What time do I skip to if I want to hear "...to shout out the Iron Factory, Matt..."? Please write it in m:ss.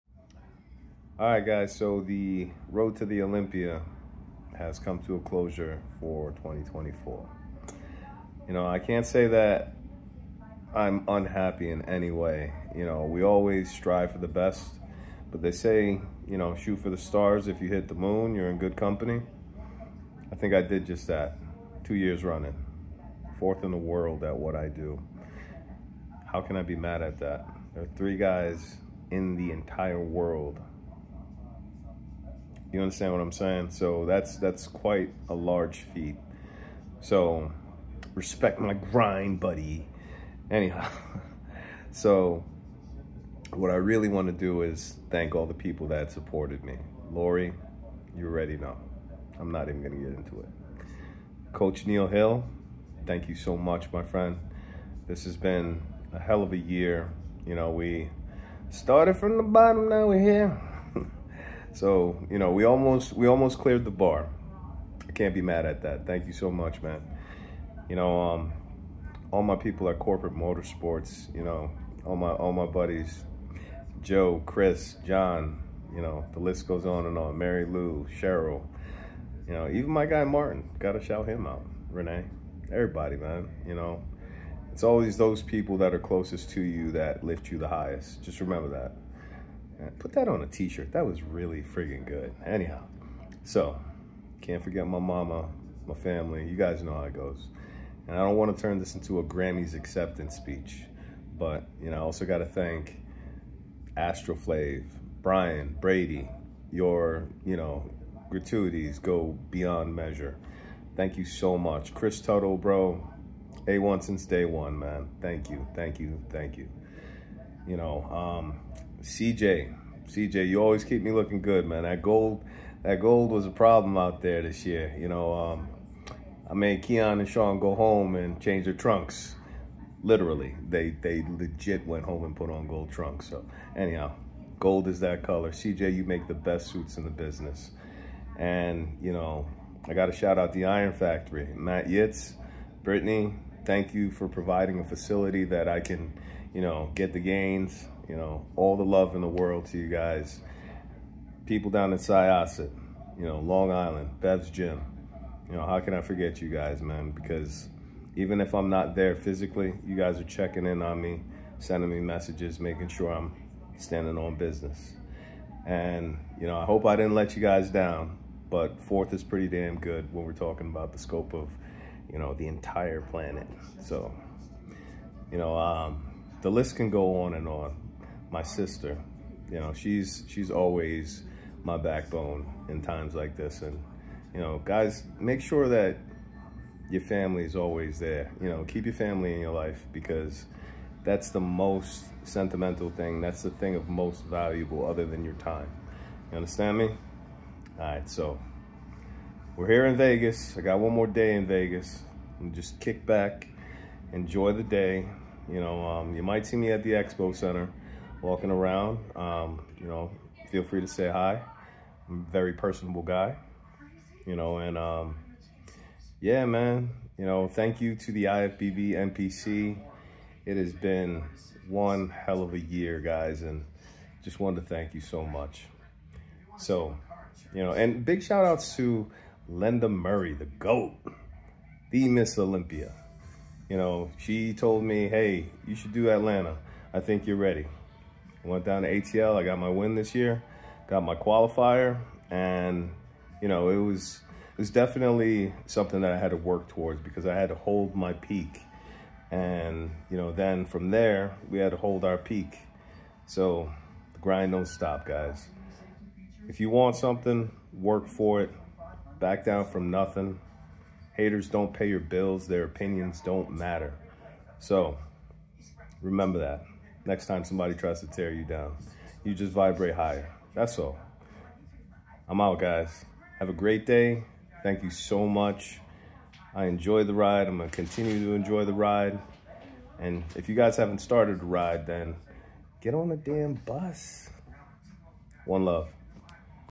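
2:20.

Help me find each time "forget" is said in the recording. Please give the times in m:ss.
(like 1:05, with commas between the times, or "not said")
1:34, 2:36.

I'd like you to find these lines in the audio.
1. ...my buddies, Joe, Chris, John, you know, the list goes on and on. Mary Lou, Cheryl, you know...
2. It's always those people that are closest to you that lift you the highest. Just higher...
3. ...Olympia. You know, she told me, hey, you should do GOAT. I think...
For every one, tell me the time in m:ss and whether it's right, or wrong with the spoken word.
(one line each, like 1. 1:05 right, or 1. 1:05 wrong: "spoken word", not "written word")
1. 1:12 right
2. 1:24 wrong: "remember", not "higher"
3. 3:52 wrong: "Atlanta", not "GOAT".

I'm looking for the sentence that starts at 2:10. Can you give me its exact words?
Literally, they they legit went home and put on gold trunks.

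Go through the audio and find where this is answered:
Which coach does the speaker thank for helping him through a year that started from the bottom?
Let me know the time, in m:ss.
0:51.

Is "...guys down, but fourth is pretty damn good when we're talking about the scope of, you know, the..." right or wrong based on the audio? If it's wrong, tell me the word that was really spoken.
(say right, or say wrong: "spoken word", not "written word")
right.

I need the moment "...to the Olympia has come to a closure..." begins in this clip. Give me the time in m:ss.
0:02.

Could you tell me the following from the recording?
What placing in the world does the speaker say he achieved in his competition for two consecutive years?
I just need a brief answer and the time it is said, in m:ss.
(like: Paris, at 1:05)
4th, at 0:23.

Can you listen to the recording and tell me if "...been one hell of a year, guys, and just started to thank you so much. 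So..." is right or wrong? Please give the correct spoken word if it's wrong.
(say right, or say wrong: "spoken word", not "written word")
wrong: "wanted", not "started".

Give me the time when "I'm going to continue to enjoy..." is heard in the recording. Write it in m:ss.
4:37.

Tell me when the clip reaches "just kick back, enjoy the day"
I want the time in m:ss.
3:22.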